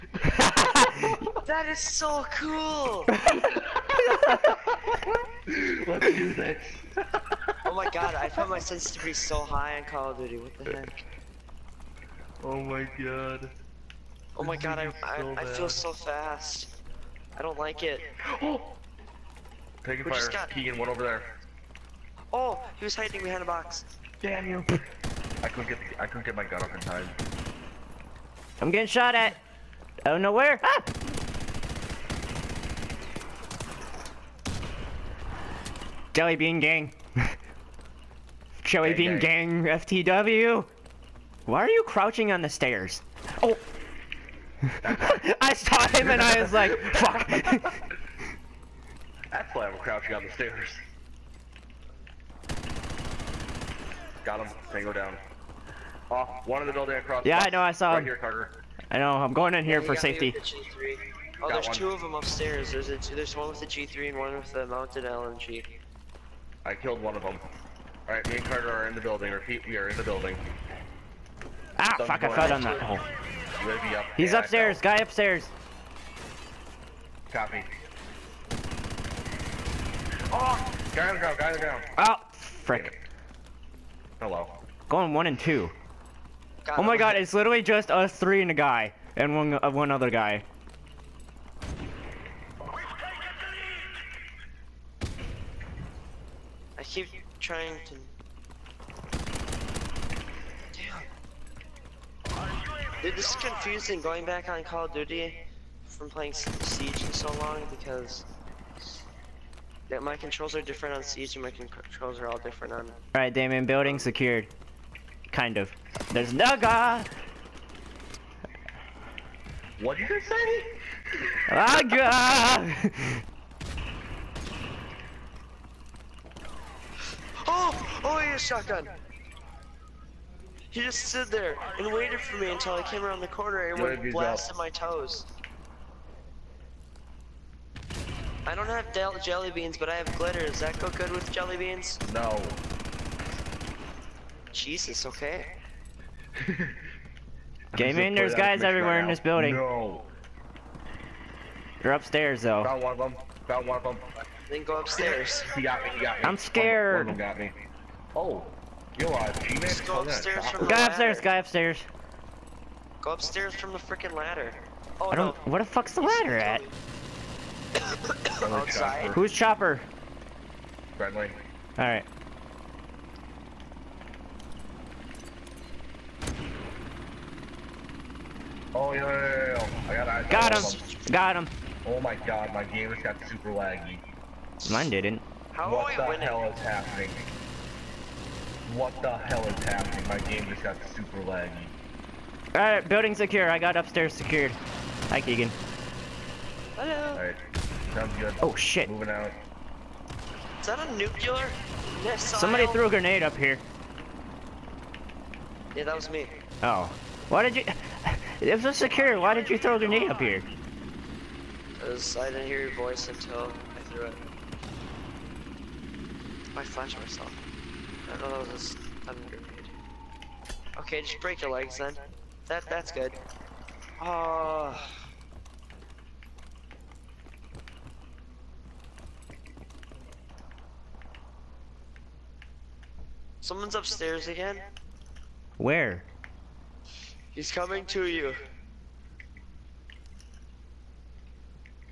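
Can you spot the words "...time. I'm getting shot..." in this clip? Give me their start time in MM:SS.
00:26.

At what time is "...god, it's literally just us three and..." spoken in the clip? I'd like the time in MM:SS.
01:26.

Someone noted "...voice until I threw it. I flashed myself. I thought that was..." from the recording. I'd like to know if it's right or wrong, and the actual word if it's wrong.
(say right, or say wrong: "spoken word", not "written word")
right.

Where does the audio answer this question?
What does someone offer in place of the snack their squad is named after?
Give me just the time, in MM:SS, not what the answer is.
02:20.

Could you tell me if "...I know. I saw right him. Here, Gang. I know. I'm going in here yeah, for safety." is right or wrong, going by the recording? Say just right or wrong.
wrong.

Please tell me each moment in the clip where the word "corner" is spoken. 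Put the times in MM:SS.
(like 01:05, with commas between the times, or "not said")
02:13.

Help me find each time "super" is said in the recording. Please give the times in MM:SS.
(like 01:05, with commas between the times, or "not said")
03:03, 03:10.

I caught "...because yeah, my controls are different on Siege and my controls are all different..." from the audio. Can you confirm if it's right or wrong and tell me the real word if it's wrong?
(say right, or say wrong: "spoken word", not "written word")
right.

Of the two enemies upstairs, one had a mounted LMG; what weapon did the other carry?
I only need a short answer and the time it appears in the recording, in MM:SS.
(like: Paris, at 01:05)
G3, at 01:03.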